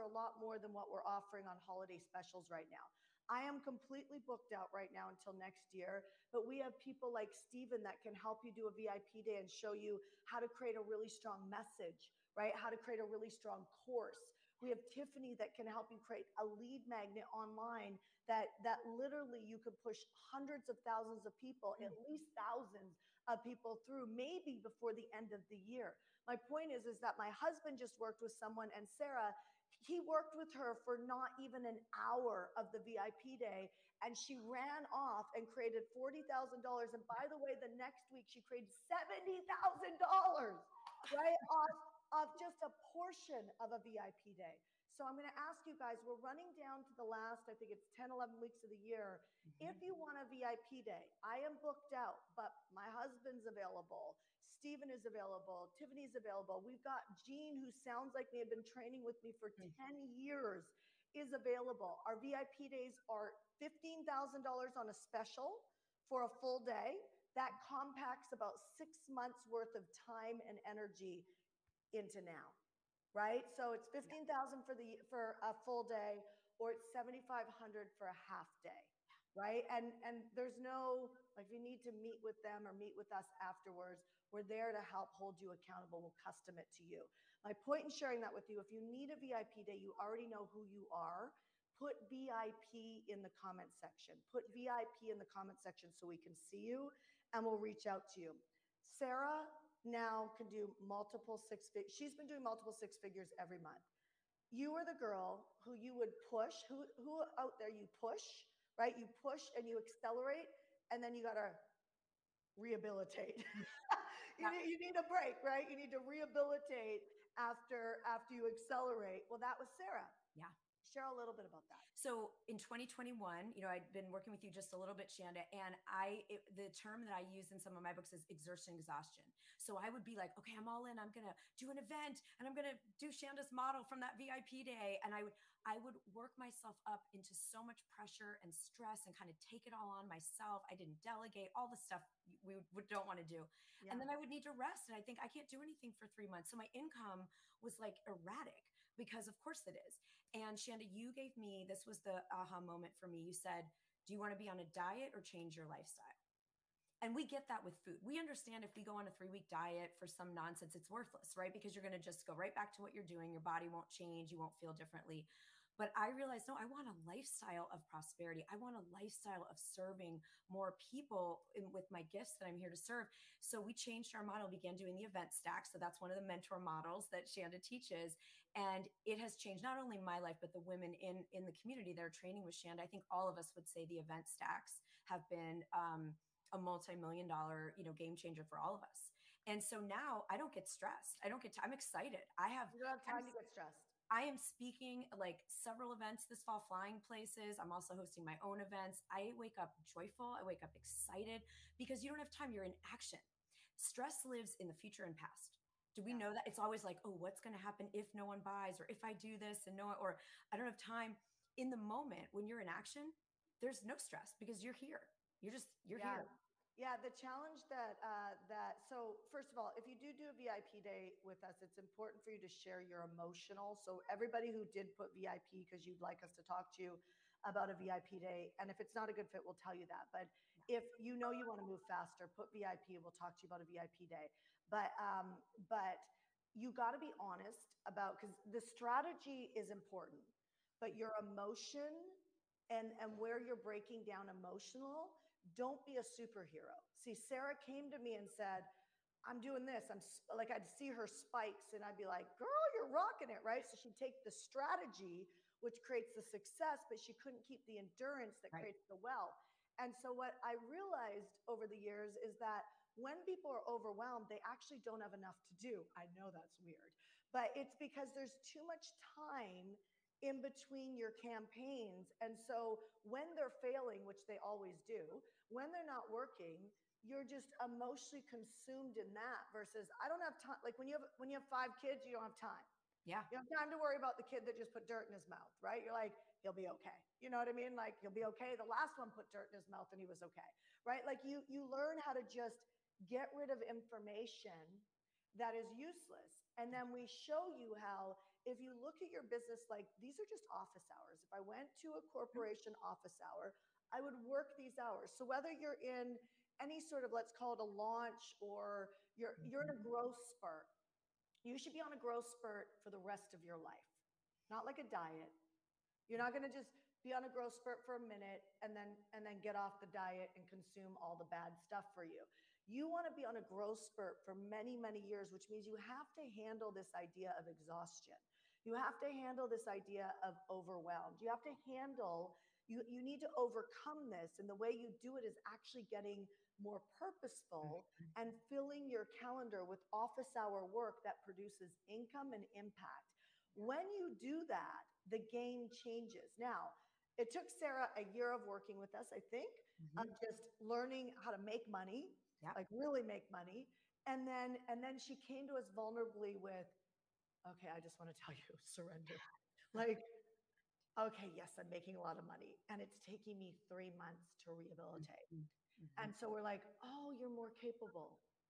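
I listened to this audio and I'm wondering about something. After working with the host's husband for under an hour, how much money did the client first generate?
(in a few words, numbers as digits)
$40,000.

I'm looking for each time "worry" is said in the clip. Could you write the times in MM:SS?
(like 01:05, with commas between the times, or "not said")
04:43.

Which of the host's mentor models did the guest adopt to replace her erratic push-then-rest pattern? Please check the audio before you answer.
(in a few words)
the event stack.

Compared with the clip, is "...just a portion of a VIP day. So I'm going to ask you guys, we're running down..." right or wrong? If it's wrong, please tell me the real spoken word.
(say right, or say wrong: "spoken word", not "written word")
right.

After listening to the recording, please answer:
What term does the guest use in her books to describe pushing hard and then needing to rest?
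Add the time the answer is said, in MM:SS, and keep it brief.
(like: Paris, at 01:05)
exertion exhaustion, at 02:08.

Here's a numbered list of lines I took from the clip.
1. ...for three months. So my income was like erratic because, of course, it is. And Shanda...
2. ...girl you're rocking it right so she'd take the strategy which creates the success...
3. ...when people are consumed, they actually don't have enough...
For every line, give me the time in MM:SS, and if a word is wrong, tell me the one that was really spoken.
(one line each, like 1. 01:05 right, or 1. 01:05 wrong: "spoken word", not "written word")
1. 02:25 right
2. 04:12 right
3. 04:22 wrong: "overwhelmed", not "consumed".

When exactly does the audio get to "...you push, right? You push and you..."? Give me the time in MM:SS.
01:47.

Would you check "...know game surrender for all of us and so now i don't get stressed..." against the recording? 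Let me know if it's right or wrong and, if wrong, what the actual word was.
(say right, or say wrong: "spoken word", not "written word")
wrong: "changer", not "surrender".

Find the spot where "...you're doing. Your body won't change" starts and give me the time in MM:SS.
02:42.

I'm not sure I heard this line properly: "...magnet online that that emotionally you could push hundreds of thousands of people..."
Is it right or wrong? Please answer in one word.
wrong.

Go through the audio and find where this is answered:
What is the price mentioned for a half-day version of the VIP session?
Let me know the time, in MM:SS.
01:16.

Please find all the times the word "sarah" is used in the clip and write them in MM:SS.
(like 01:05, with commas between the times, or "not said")
00:28, 01:38, 01:59, 04:07, 05:47.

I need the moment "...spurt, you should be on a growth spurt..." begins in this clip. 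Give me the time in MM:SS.
05:10.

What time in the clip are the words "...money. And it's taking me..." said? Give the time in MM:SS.
06:02.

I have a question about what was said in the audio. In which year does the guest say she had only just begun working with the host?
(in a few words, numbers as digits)
2021.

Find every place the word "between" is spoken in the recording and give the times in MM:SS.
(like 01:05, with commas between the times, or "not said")
04:30.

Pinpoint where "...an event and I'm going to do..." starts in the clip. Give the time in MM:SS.
02:11.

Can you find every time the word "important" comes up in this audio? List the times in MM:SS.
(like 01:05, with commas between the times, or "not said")
03:41, 03:59.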